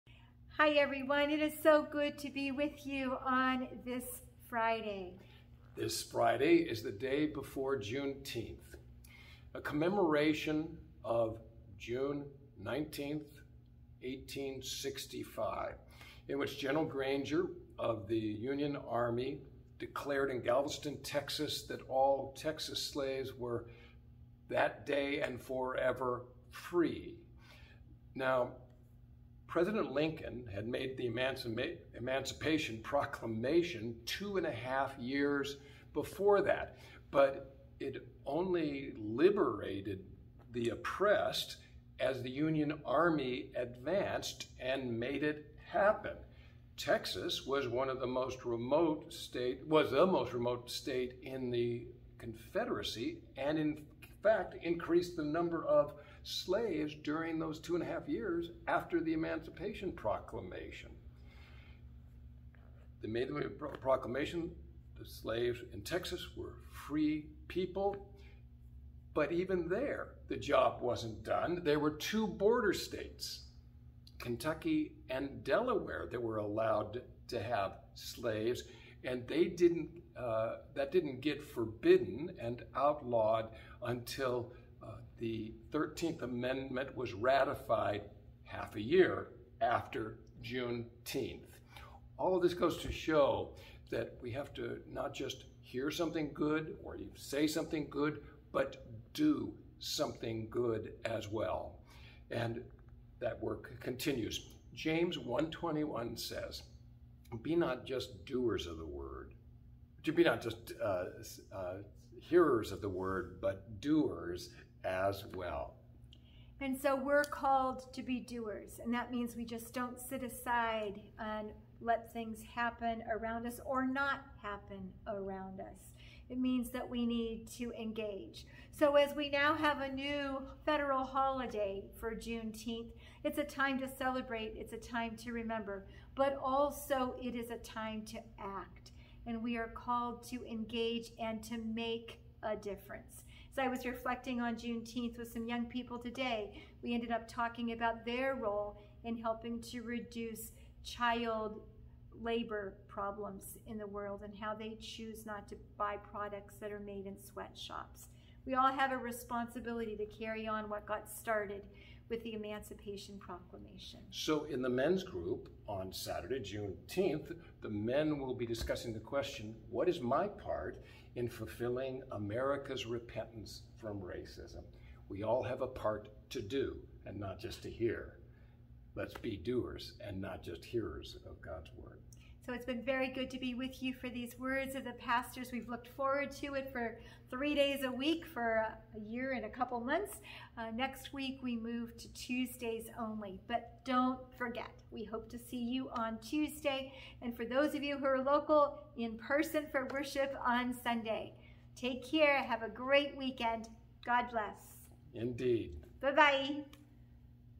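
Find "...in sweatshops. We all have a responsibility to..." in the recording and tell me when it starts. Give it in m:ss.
2:37.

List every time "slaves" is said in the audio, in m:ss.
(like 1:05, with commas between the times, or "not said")
0:22, 0:56, 1:05, 1:17.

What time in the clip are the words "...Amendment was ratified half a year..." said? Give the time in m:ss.
1:26.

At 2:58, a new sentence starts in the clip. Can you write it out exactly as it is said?
Let's be doers and not just hearers of God's word.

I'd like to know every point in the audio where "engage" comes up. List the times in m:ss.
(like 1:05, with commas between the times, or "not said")
2:07, 2:20.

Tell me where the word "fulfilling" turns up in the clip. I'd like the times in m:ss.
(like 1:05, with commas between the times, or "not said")
2:51.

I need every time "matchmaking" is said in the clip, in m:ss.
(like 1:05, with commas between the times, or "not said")
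not said.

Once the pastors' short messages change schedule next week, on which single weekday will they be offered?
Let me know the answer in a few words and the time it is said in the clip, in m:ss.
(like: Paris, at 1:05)
Tuesdays, at 3:12.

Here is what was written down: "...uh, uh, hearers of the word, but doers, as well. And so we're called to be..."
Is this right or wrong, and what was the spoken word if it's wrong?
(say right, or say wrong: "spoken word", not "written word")
right.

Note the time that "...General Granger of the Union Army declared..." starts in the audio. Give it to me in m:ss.
0:16.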